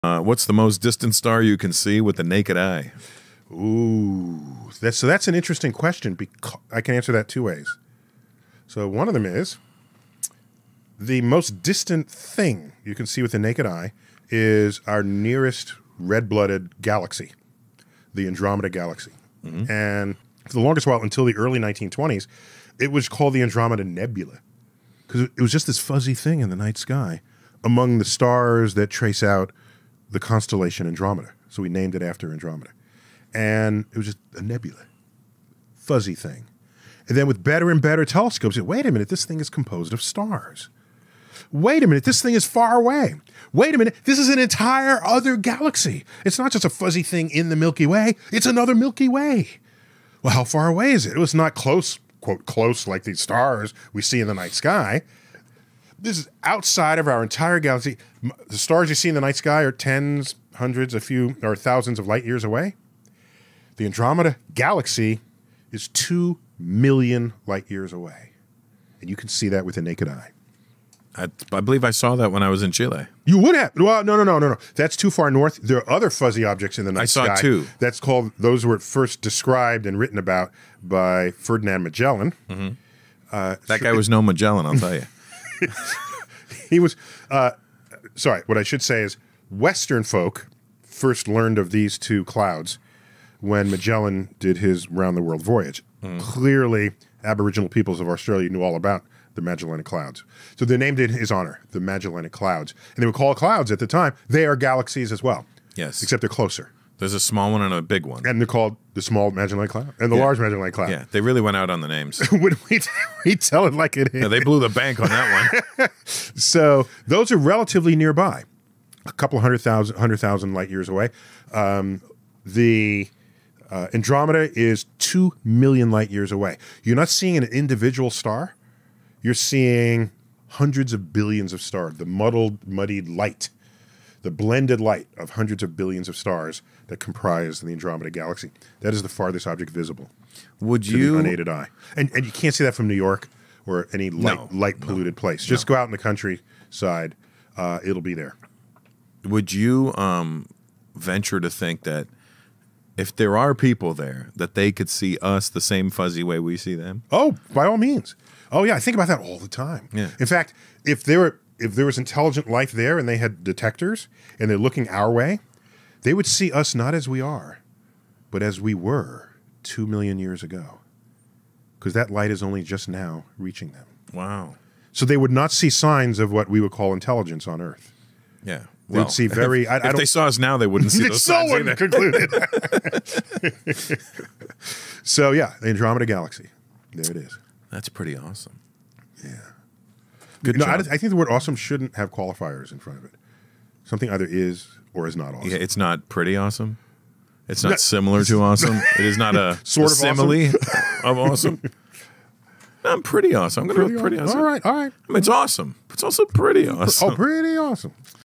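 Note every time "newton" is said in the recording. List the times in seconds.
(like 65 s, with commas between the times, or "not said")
not said.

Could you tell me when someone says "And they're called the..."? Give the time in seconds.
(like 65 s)
108 s.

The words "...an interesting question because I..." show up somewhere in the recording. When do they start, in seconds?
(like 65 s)
5 s.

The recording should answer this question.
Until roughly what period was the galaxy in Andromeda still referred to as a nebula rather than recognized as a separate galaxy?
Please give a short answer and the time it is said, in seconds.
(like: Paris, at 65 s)
early 1920s, at 21 s.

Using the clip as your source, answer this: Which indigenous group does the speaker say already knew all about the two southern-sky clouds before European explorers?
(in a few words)
Aboriginal peoples of Australia.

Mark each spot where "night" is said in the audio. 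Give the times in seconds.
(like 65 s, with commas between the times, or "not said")
26 s, 54 s, 59 s, 76 s.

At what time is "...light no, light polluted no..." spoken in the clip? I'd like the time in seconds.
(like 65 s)
144 s.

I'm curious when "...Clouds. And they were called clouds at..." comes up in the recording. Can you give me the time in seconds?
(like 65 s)
102 s.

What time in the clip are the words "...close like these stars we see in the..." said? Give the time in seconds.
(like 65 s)
52 s.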